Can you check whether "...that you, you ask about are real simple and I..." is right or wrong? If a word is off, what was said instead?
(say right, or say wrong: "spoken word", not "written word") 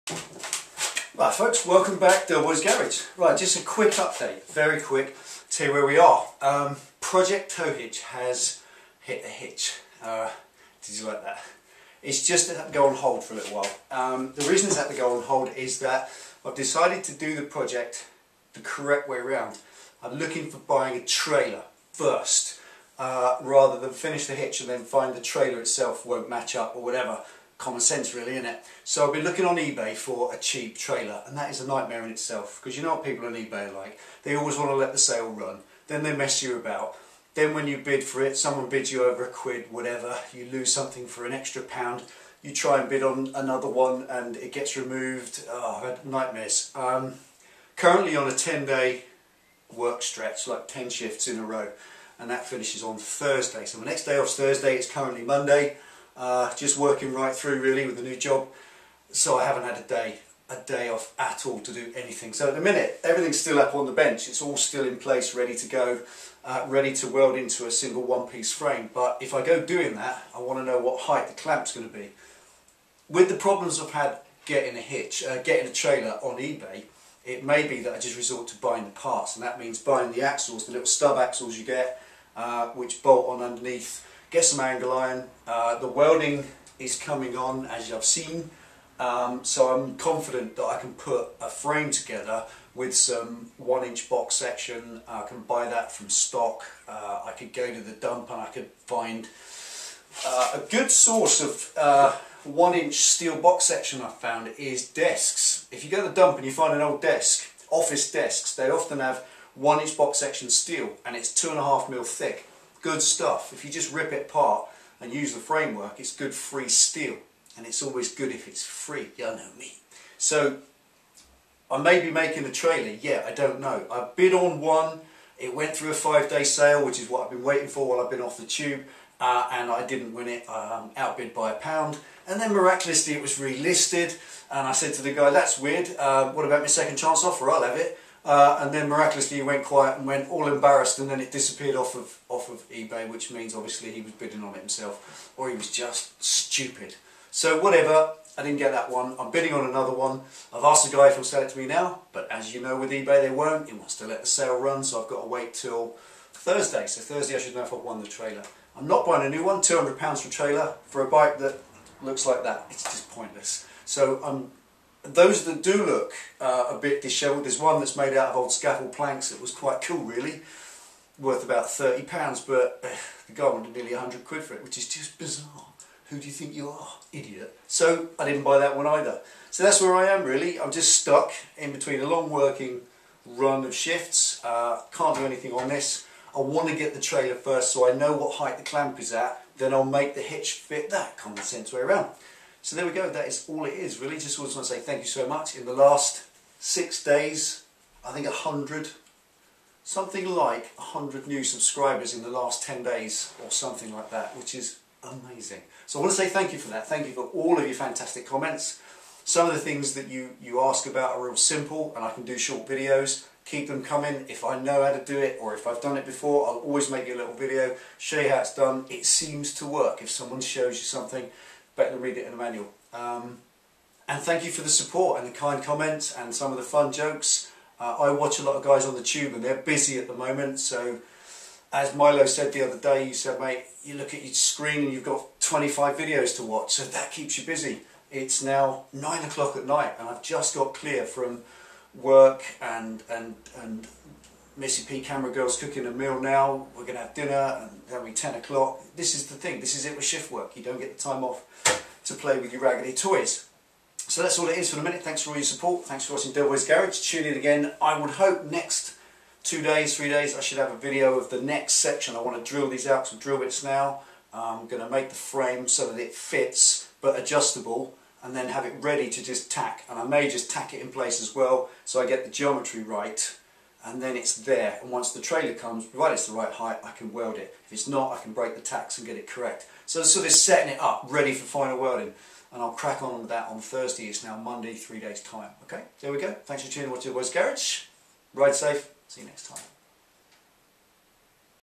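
right.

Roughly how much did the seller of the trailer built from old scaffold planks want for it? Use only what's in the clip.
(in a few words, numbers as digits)
Nearly £100.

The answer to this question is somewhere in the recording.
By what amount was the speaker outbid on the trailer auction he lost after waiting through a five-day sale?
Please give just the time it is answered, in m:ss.
2:11.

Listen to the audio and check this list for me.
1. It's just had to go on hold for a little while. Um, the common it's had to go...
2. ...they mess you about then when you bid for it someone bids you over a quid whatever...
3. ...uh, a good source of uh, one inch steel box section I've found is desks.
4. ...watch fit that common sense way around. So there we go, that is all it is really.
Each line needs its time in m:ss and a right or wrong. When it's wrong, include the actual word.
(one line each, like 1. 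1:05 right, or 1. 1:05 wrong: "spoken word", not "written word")
1. 0:12 wrong: "reason", not "common"
2. 0:36 right
3. 1:40 right
4. 3:10 wrong: "hitch", not "watch".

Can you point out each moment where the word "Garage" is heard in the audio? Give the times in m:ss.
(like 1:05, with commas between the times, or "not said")
0:02, 4:16, 4:47.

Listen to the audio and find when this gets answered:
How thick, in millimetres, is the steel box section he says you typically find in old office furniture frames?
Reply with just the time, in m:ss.
1:51.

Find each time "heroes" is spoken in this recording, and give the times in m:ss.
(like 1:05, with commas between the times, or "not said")
not said.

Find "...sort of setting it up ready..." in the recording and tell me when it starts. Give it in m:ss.
4:40.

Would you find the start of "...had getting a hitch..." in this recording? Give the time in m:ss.
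1:13.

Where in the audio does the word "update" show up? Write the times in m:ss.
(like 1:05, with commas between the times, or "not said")
0:03.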